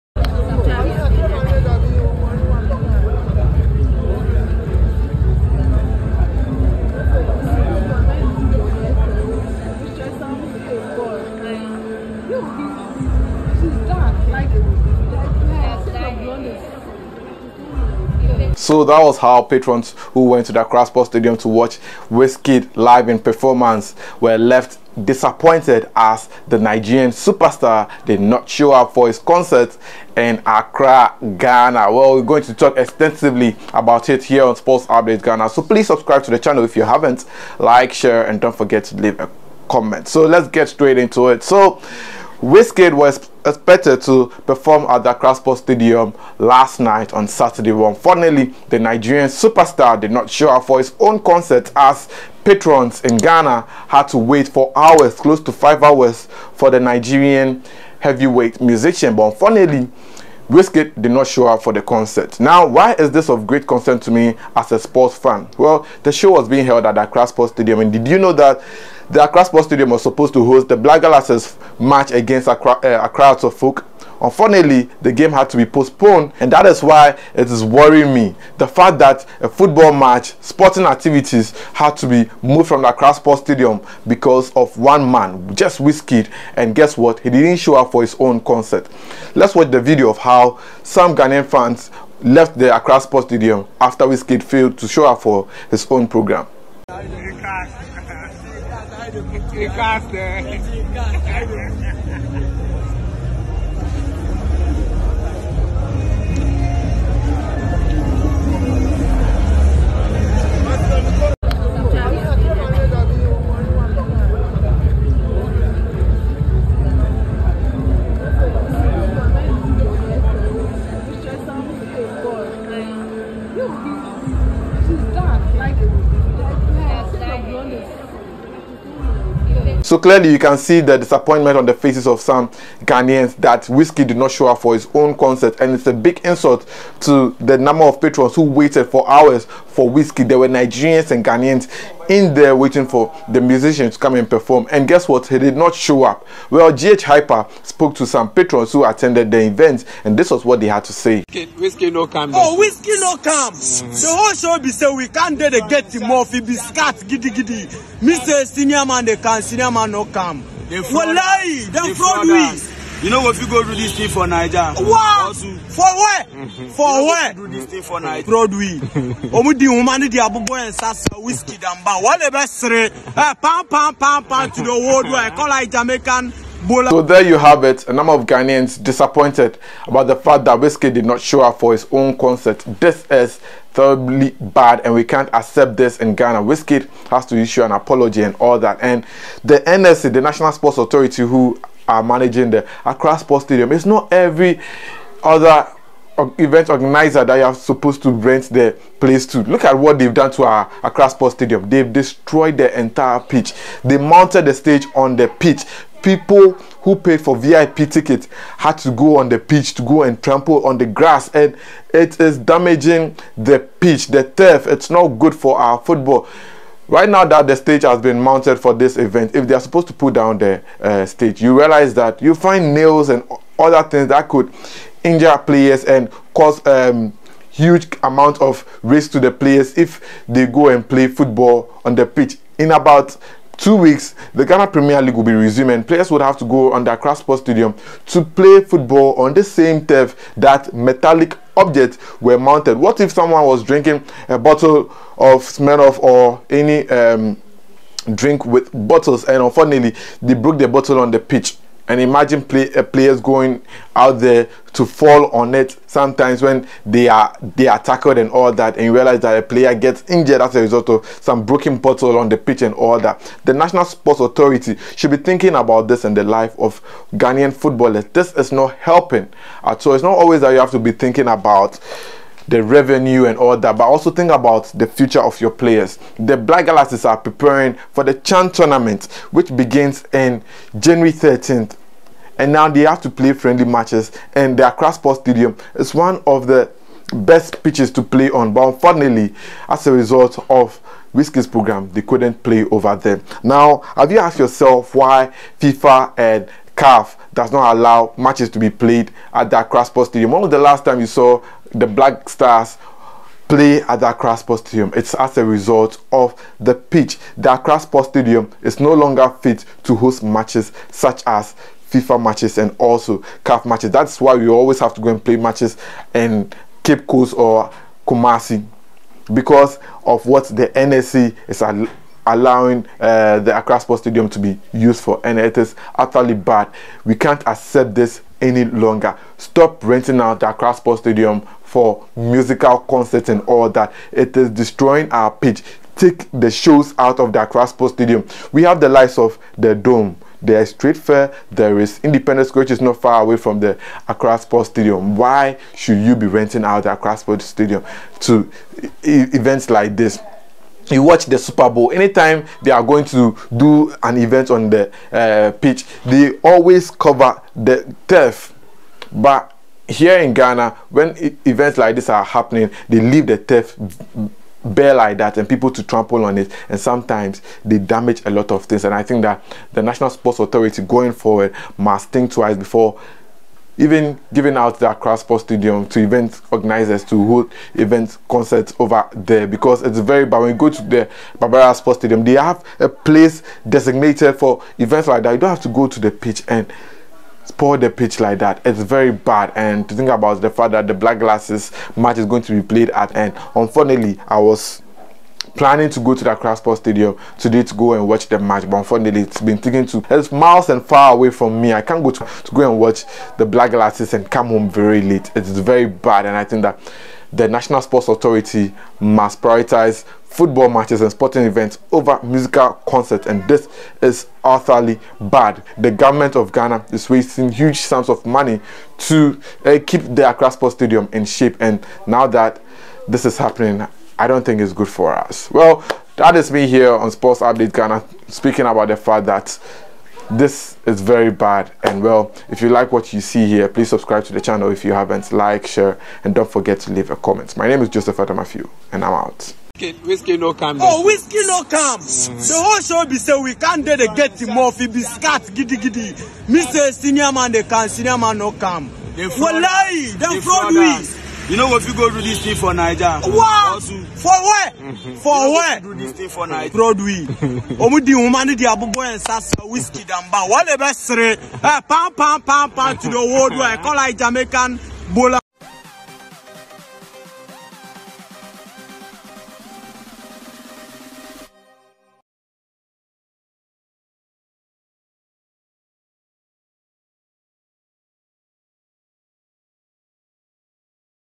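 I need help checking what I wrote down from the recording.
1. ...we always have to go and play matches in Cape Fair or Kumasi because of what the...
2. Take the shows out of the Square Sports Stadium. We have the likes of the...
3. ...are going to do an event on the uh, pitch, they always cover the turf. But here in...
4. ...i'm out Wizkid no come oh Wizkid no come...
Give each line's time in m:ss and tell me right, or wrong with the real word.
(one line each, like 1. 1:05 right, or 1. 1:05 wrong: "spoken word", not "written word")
1. 5:14 wrong: "Coast", not "Fair"
2. 5:35 wrong: "Accra", not "Square"
3. 5:52 right
4. 7:19 right.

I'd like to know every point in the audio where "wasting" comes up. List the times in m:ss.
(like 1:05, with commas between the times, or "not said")
6:57.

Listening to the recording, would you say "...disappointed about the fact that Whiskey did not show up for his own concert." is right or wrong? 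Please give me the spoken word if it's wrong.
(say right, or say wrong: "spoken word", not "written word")
right.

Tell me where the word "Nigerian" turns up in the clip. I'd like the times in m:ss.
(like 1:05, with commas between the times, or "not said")
0:26, 0:48, 0:56, 2:20.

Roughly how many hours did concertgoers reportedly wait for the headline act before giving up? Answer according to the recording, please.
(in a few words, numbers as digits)
5.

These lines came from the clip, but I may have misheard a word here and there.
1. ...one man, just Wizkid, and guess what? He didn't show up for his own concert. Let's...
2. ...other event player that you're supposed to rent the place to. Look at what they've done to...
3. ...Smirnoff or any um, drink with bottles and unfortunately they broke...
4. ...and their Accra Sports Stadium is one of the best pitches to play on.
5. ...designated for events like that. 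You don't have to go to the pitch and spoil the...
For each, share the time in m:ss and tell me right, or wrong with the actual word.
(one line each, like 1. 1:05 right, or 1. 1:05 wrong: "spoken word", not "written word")
1. 1:24 right
2. 3:15 wrong: "organizer", not "player"
3. 4:05 right
4. 4:44 right
5. 6:23 right.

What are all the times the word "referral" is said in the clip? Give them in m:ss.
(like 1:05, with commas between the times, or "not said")
not said.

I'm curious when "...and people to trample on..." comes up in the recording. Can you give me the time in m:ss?
6:05.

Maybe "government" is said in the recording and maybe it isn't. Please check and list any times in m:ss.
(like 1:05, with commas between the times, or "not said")
6:55.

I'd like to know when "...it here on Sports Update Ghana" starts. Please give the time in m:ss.
0:34.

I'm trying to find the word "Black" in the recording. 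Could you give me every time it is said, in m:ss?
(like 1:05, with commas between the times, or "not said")
1:10, 4:36, 5:01, 6:30, 6:43.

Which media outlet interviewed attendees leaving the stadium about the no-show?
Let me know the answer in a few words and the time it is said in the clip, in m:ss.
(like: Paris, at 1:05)
GH Hyper, at 2:26.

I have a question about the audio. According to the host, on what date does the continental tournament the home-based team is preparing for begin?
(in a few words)
January 13.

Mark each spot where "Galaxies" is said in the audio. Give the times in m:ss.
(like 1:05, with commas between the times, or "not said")
1:11, 4:36, 6:31, 6:43.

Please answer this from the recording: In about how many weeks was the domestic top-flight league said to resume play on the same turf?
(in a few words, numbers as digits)
2.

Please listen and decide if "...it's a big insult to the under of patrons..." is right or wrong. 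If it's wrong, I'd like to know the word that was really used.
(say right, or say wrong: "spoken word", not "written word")
wrong: "number", not "under".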